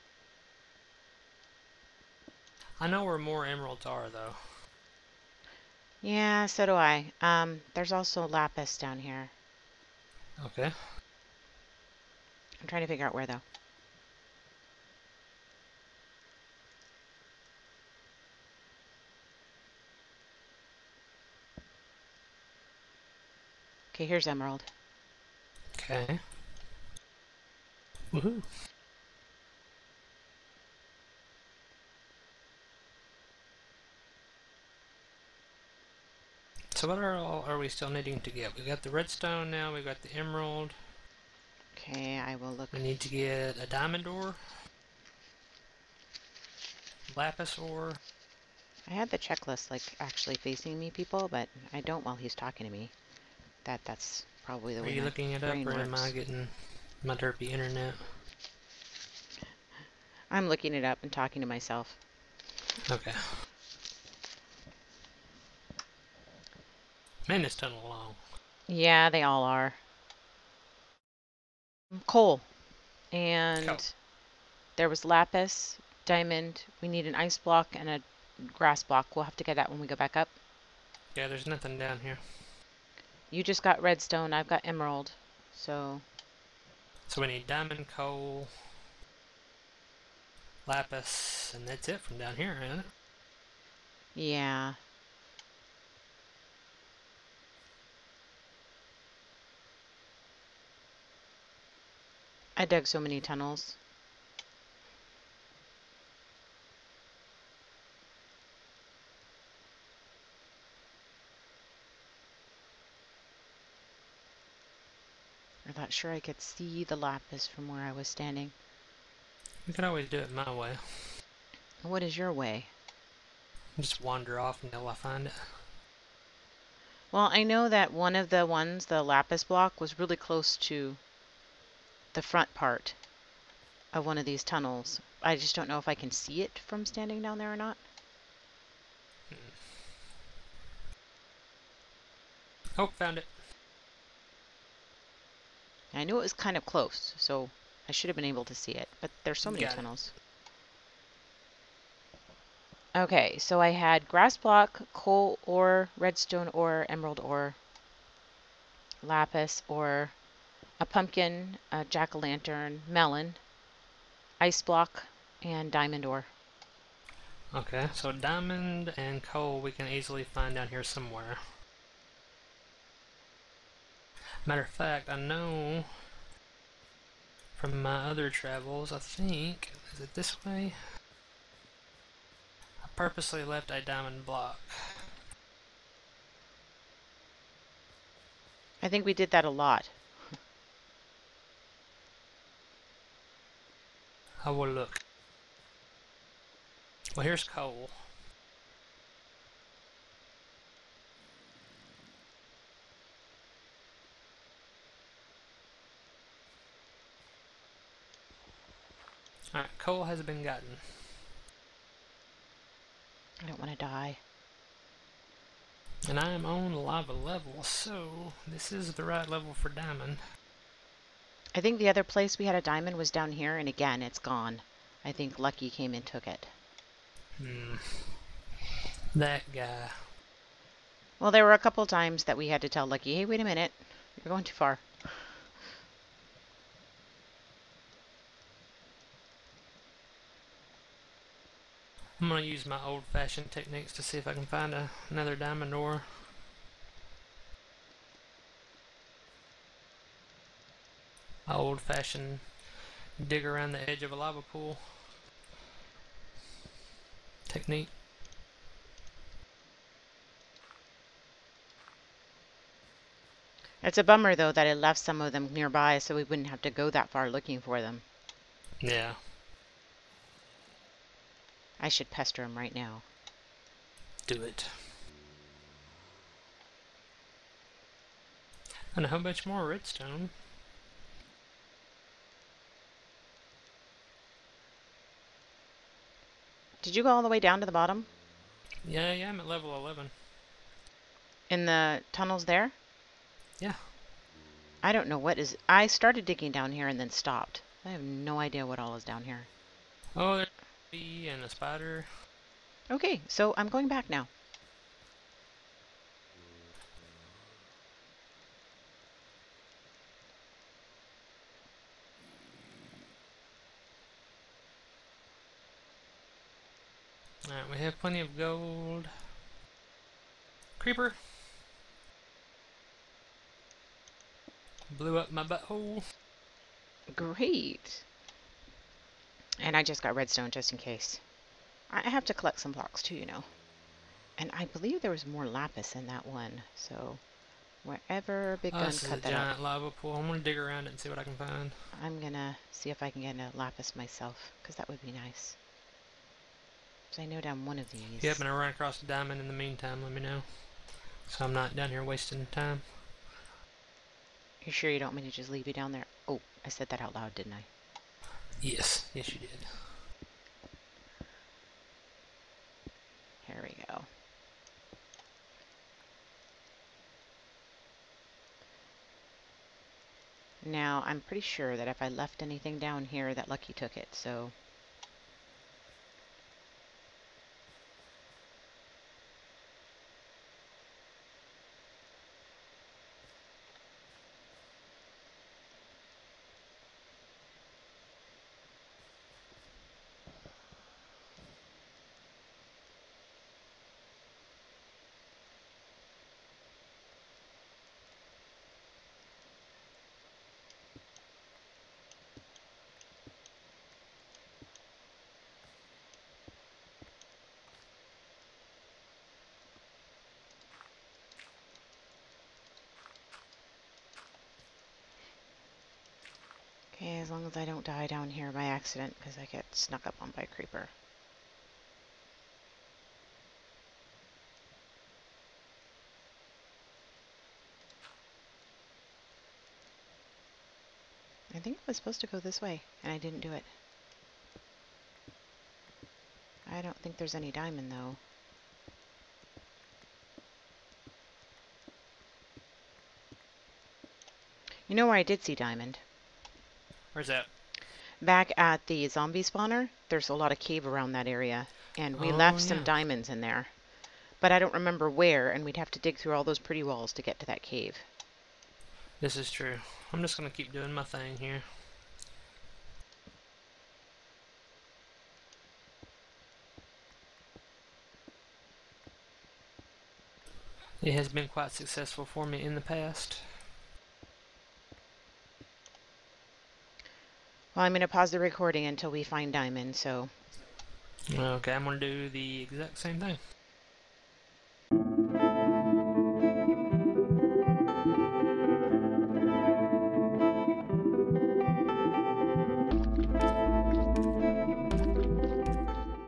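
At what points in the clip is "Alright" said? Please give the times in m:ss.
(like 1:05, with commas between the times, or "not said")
3:29, 5:17.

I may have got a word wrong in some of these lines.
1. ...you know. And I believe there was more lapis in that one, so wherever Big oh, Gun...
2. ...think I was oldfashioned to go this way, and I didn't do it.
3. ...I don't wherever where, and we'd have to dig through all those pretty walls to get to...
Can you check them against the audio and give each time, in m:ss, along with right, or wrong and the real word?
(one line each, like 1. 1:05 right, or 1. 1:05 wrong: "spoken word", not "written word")
1. 5:33 right
2. 7:11 wrong: "supposed", not "oldfashioned"
3. 7:34 wrong: "remember", not "wherever".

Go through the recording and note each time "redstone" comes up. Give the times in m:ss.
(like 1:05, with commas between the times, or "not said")
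0:38, 1:23, 2:35, 4:39, 5:30.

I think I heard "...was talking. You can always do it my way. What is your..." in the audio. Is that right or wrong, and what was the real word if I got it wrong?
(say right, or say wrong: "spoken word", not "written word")
wrong: "standing", not "talking".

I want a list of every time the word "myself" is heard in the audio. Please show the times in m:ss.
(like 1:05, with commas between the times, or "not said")
1:01, 5:43.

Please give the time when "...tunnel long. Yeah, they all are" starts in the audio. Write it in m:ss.
1:07.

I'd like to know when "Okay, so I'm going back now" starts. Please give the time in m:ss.
5:02.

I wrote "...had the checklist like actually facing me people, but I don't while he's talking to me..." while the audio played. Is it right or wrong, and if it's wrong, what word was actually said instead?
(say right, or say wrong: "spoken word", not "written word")
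right.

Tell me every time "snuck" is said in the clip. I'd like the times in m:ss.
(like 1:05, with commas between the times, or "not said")
6:59.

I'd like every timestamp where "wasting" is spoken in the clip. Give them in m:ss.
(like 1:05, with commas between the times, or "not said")
5:52.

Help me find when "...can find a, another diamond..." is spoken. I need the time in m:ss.
4:04.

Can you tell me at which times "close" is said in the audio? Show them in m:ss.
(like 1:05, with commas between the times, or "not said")
2:10, 2:26.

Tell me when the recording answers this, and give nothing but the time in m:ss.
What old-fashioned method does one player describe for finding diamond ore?
4:13.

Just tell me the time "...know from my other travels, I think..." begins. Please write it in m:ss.
2:55.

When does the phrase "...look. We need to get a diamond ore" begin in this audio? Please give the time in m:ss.
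0:42.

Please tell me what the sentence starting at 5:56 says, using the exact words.
Oh, I said that out loud, didn't I?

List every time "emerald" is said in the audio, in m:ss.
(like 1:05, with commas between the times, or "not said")
0:03, 0:24, 0:40, 1:24, 2:36.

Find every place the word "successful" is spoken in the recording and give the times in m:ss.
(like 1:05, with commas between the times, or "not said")
7:51.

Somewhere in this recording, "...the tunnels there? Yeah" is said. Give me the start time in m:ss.
4:51.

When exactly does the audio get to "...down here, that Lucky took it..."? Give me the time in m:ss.
6:12.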